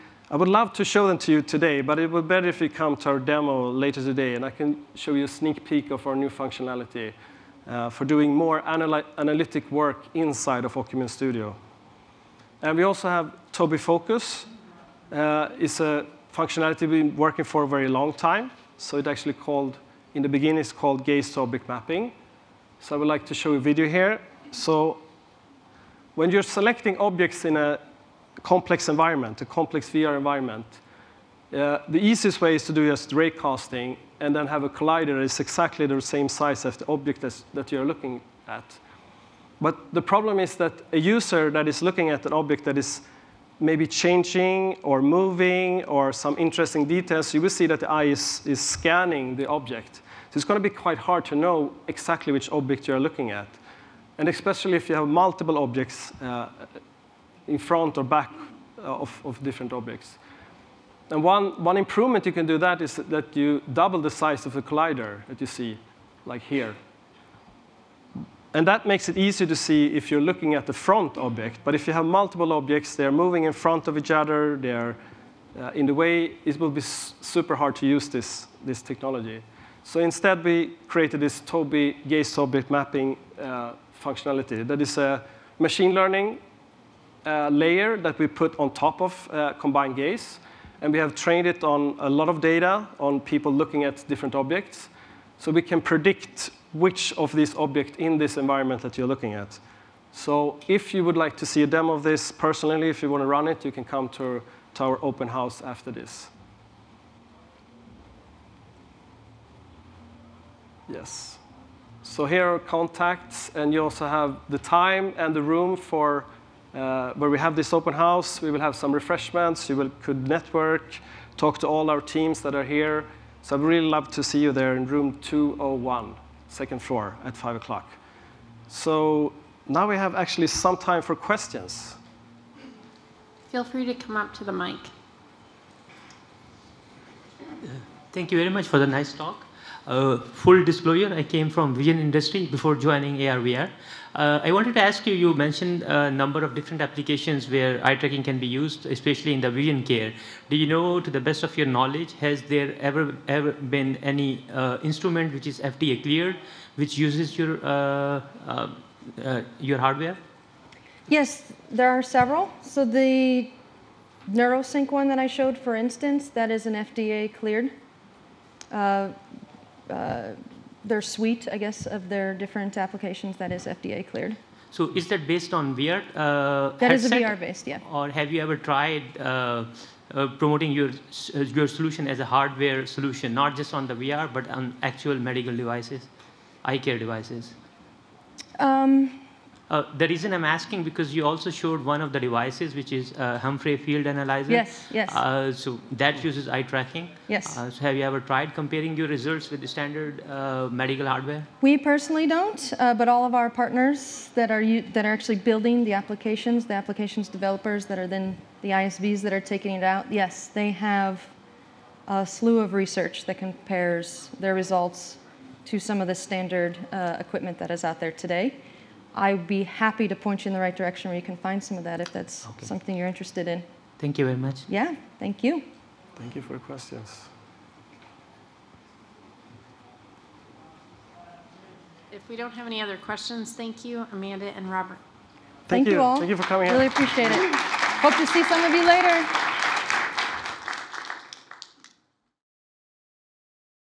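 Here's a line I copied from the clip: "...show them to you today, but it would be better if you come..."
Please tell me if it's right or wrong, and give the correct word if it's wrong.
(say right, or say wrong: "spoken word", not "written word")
right.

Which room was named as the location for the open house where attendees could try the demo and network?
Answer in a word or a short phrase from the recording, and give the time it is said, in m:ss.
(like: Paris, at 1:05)
room 201, at 2:04.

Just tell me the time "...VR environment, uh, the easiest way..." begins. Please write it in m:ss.
0:29.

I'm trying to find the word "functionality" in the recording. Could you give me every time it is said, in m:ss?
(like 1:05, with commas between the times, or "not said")
0:06, 0:16, 1:24.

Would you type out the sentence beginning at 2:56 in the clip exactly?
Uh, that is a VR based, yeah.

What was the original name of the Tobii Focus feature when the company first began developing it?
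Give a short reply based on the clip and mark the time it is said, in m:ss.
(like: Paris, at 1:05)
gaze to object mapping, at 0:21.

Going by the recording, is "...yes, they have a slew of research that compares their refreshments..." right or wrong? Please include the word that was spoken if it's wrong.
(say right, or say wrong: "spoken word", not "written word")
wrong: "results", not "refreshments".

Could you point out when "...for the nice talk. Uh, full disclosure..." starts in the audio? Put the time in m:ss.
2:18.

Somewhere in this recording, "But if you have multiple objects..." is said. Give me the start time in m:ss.
1:11.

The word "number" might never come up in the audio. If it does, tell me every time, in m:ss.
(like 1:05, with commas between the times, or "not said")
2:26.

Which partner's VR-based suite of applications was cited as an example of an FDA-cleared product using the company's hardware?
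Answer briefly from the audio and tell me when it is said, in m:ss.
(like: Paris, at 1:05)
NeuroSync, at 2:44.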